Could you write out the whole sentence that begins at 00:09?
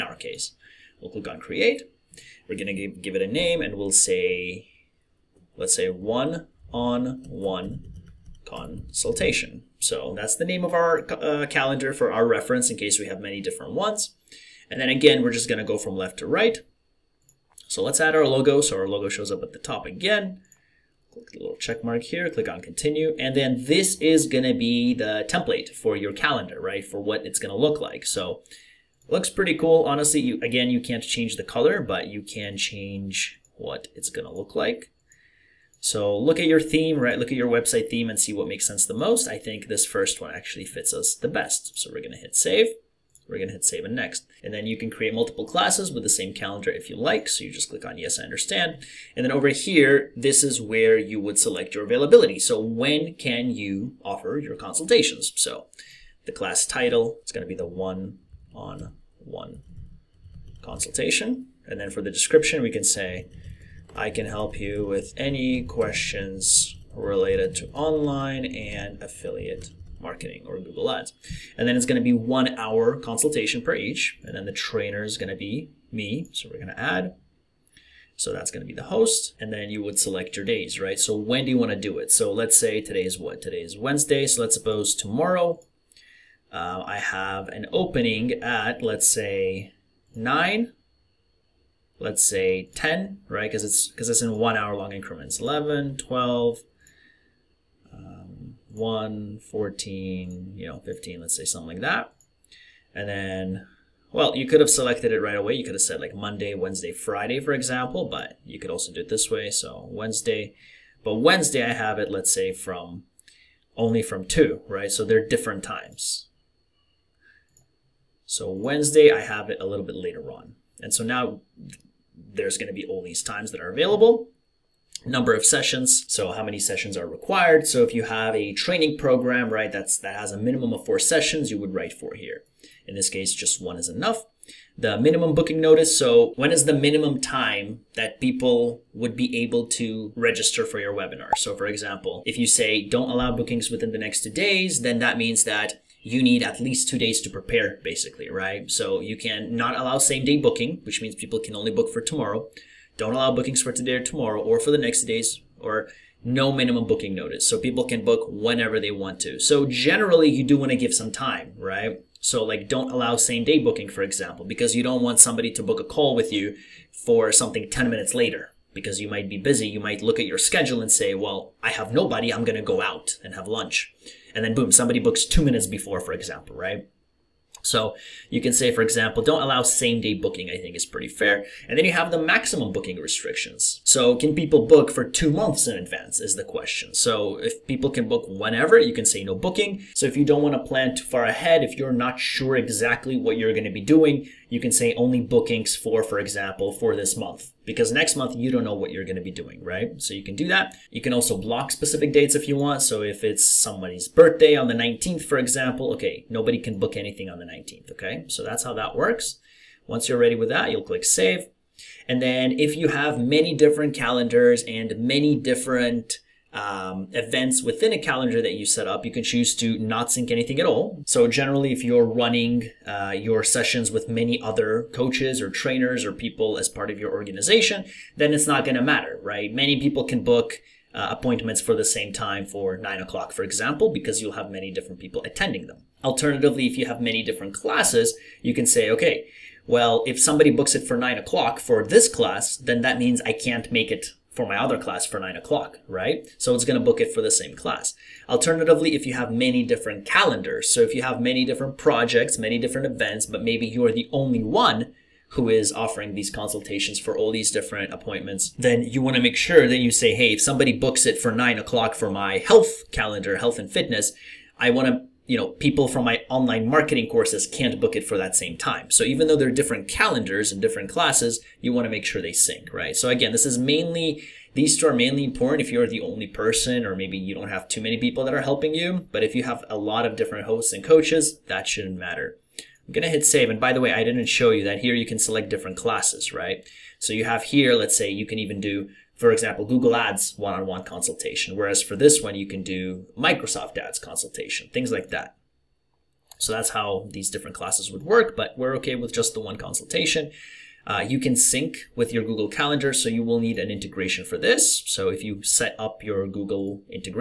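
So that's the name of our uh, calendar for our reference in case we have many different ones.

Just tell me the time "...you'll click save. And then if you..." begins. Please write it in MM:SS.
03:30.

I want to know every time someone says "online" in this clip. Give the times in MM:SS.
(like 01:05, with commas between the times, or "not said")
01:07, 04:26.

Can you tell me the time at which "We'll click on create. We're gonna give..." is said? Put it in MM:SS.
00:01.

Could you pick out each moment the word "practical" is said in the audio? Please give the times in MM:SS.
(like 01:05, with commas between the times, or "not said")
not said.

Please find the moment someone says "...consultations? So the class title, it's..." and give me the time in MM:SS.
00:54.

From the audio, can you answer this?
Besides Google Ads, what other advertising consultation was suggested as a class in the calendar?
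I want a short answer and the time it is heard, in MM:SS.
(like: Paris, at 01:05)
Microsoft Ads, at 04:53.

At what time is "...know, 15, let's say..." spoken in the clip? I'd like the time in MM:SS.
01:40.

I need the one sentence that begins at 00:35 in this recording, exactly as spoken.
So look at your theme, right?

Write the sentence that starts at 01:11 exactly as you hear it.
And then it's going to be one hour consultation per each.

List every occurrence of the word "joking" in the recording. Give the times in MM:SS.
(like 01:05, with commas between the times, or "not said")
not said.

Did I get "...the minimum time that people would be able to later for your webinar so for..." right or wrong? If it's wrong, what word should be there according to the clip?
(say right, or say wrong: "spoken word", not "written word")
wrong: "register", not "later".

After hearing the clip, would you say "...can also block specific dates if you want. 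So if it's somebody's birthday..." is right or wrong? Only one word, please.
right.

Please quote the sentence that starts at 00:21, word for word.
Click the little check mark here, click on continue.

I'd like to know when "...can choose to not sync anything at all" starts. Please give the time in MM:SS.
03:39.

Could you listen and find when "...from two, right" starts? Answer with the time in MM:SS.
01:54.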